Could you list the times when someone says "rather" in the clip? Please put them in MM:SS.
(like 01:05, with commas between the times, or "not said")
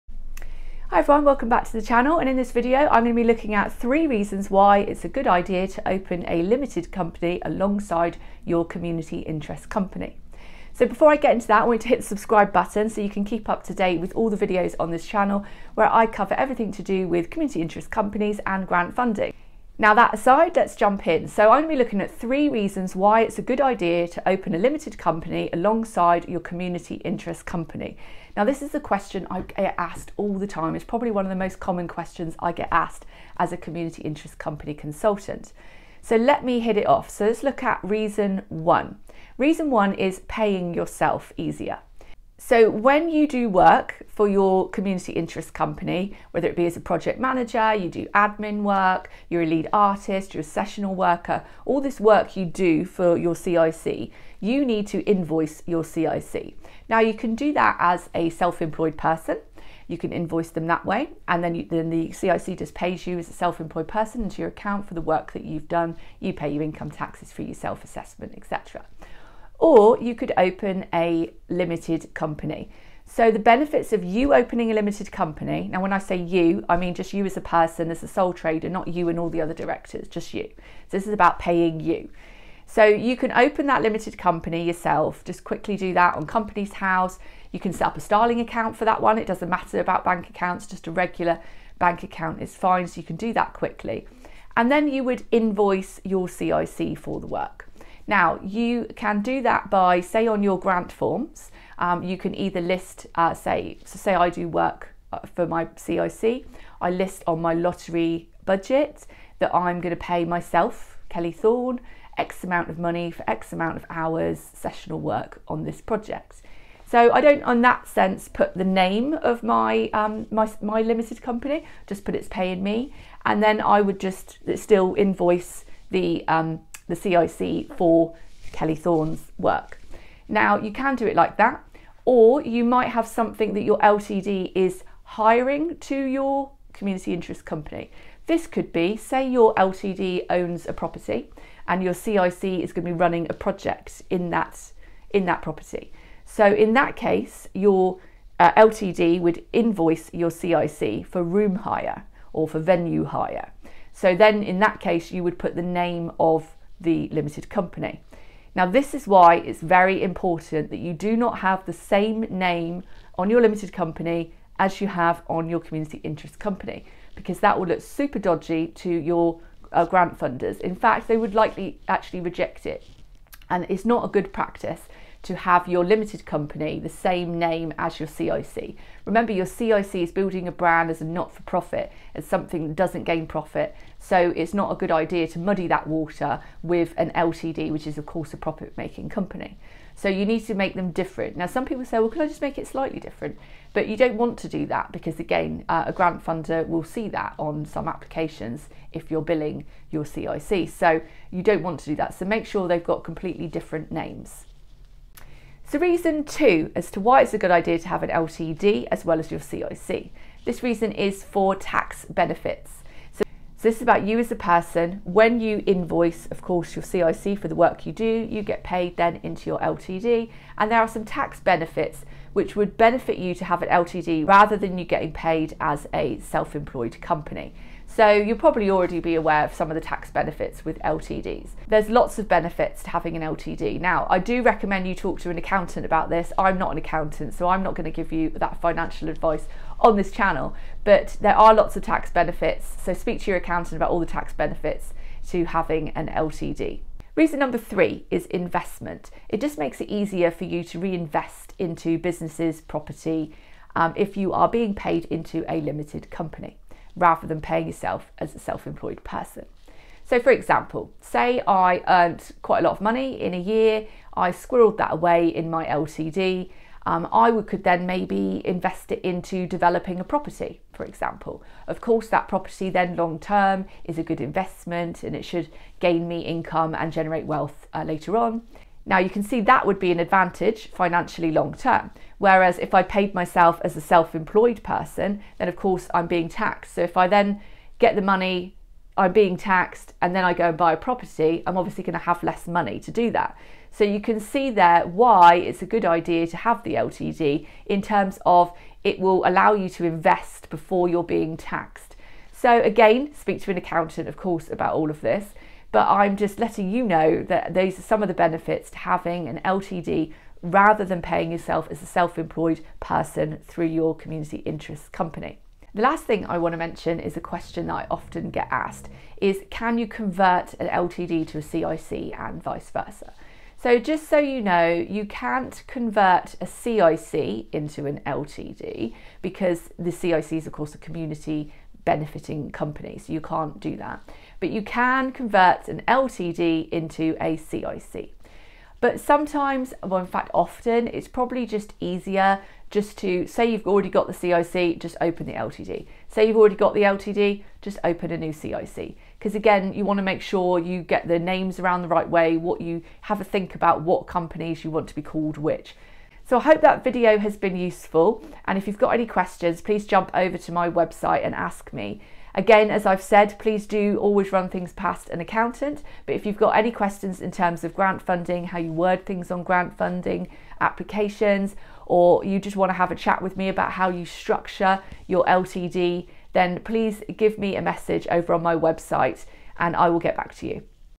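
03:44, 04:16, 05:10.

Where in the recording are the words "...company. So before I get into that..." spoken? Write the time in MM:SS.
00:09.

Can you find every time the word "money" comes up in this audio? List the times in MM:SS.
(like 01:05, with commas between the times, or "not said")
01:52, 04:22, 04:48, 04:52.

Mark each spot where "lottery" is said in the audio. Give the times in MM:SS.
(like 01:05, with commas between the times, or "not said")
01:47.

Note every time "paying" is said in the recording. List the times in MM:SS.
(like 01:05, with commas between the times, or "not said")
00:40, 01:21, 02:02, 04:17, 05:11.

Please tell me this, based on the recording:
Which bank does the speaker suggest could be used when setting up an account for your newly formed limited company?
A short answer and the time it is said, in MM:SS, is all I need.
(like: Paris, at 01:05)
Starling, at 01:28.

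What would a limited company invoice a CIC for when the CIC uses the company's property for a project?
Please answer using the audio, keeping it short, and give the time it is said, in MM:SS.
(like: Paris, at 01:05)
Room hire, at 02:31.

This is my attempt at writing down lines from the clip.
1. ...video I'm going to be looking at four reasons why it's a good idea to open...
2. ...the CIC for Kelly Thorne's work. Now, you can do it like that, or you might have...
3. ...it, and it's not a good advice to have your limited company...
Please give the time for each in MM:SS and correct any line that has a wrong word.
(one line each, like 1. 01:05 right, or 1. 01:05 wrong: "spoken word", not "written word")
1. 00:02 wrong: "three", not "four"
2. 02:06 right
3. 02:52 wrong: "practice", not "advice".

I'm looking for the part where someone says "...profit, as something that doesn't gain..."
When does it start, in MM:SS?
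03:01.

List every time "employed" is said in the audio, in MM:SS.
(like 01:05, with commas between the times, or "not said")
00:58, 01:03, 03:46, 04:18, 04:44, 05:12.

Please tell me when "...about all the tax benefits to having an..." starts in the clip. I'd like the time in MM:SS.
04:03.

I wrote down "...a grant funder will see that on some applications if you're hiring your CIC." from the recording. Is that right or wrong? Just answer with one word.
wrong.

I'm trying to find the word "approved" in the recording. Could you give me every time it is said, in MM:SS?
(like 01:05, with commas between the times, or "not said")
not said.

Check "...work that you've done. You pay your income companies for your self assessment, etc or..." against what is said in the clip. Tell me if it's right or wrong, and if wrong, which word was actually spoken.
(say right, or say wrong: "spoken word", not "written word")
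wrong: "taxes", not "companies".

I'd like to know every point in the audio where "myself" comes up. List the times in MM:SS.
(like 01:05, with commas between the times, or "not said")
01:50, 04:43.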